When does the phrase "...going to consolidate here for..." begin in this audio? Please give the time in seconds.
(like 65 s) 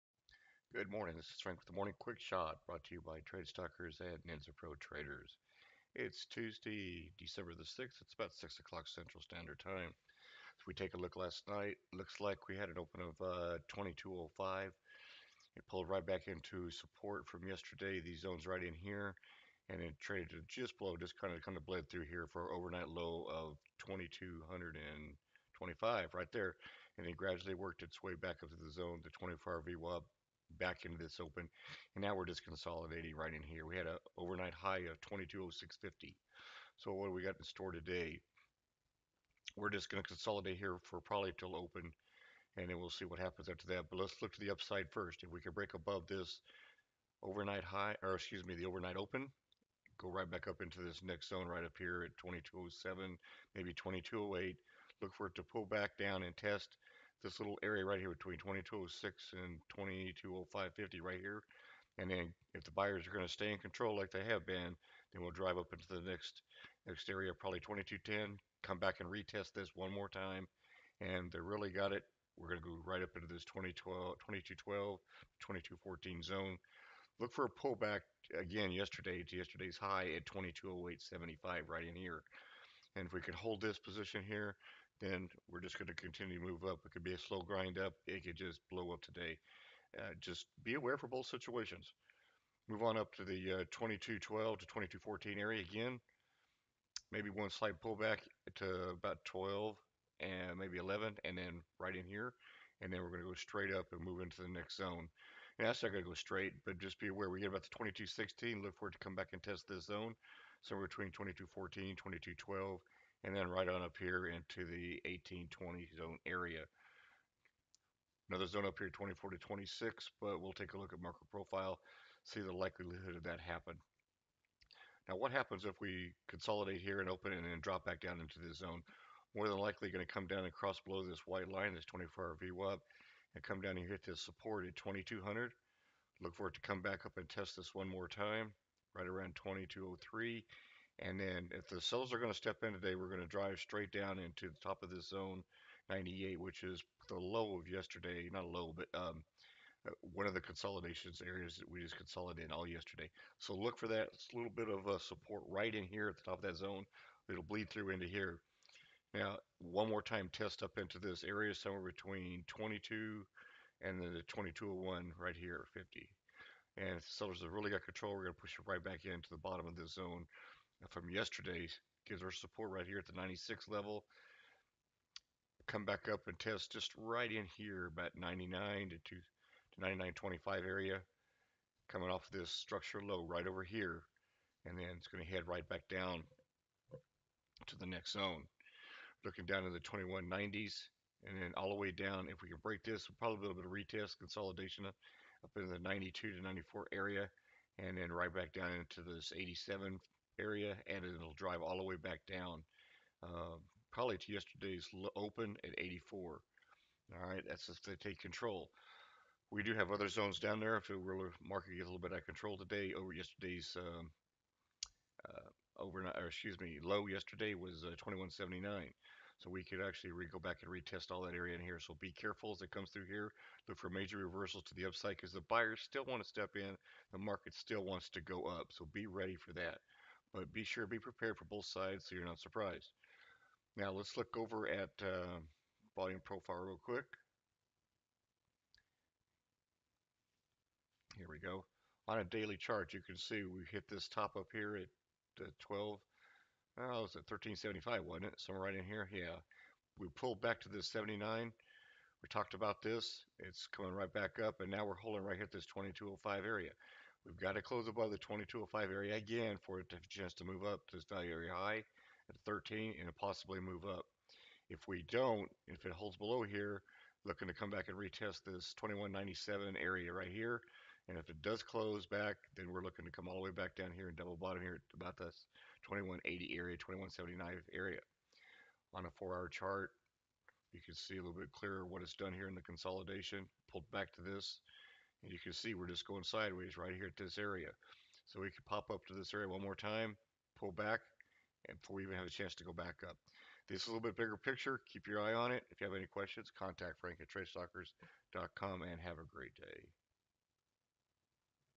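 39 s.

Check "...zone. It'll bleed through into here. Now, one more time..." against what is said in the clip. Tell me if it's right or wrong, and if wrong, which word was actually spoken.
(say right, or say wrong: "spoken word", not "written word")
right.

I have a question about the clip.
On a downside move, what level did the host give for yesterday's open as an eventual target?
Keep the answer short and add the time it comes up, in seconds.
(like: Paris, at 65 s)
84, at 205 s.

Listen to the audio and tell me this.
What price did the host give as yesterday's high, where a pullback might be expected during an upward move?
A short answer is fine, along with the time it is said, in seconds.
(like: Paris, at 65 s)
2208.75, at 80 s.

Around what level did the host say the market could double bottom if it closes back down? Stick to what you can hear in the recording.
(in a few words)
2180.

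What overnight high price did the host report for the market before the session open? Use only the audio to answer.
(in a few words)
2206.50.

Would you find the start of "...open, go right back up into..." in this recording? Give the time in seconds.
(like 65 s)
48 s.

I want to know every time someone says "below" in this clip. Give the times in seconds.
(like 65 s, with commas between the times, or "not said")
20 s, 130 s, 266 s.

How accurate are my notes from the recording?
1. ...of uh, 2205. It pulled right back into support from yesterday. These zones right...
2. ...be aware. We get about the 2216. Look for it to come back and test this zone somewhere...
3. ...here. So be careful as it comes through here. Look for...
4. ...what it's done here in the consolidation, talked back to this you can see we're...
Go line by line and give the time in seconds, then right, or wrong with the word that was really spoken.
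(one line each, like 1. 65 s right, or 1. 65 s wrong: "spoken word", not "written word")
1. 13 s right
2. 106 s right
3. 221 s right
4. 281 s wrong: "pulled", not "talked".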